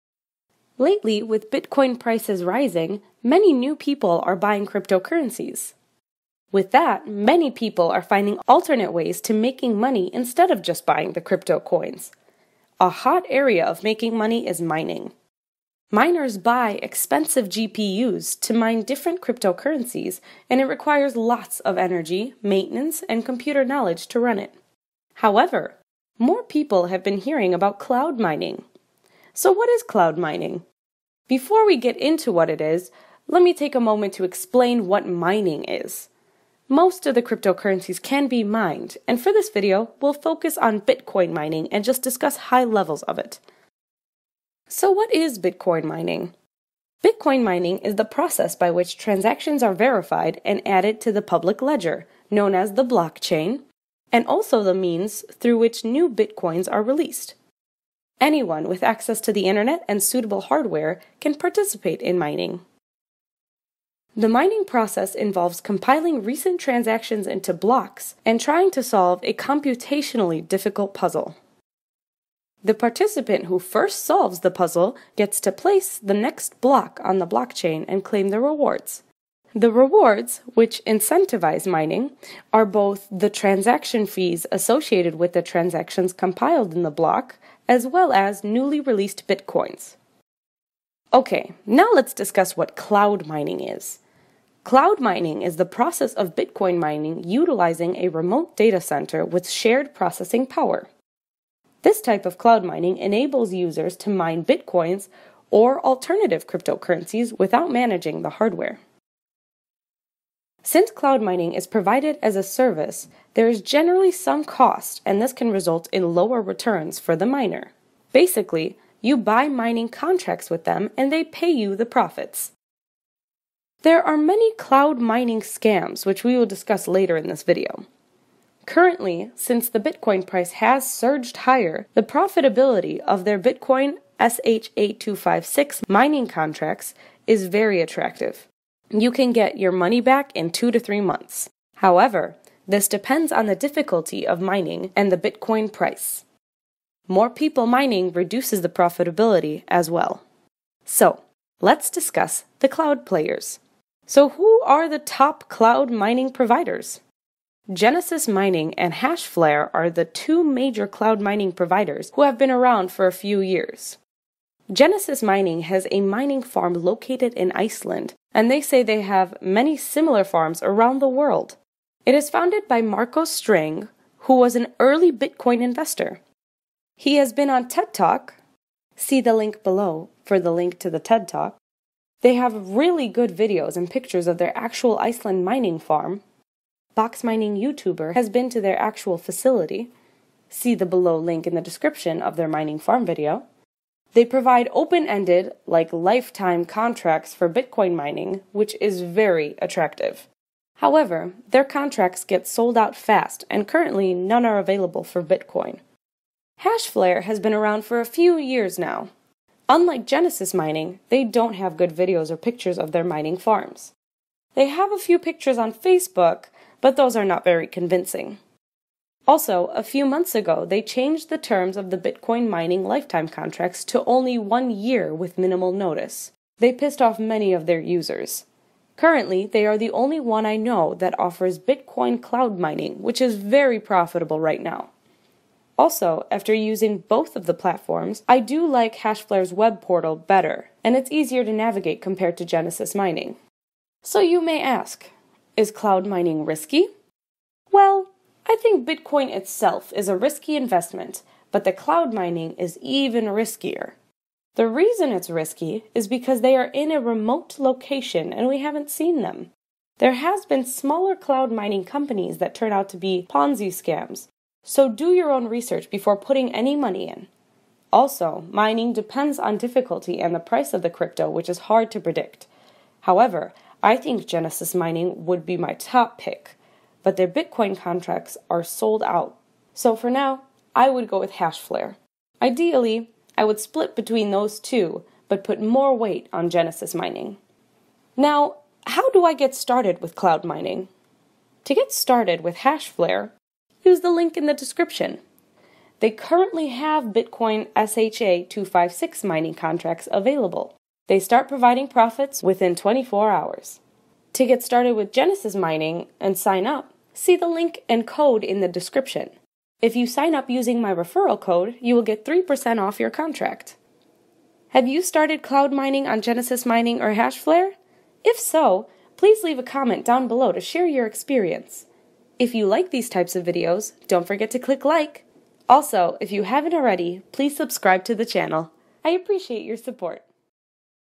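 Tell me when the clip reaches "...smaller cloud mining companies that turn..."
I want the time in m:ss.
4:20.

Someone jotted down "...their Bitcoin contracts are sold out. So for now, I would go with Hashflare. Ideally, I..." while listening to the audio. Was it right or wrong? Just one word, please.
right.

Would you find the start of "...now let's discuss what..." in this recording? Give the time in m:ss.
1:31.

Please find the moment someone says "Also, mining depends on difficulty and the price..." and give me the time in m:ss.
4:27.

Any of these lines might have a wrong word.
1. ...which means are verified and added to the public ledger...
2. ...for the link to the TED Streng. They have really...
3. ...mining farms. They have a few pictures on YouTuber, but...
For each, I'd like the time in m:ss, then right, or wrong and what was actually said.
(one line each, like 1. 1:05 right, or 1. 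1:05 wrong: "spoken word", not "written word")
1. 0:48 wrong: "transactions", not "means"
2. 3:00 wrong: "Talk", not "Streng"
3. 3:33 wrong: "Facebook", not "YouTuber".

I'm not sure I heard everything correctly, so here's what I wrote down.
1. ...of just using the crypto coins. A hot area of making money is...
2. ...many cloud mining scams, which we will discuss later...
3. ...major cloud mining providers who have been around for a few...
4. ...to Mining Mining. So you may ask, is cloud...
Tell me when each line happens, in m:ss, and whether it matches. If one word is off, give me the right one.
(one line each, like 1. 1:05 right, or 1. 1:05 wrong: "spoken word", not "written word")
1. 0:10 wrong: "buying", not "using"
2. 2:04 right
3. 2:40 right
4. 4:02 wrong: "Genesis", not "Mining".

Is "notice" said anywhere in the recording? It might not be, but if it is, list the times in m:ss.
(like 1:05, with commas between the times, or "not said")
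3:45.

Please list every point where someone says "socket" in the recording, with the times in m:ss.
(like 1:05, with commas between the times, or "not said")
not said.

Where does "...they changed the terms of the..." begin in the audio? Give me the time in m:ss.
3:40.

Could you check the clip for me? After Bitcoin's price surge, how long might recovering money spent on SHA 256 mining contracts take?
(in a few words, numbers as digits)
2 to 3 months.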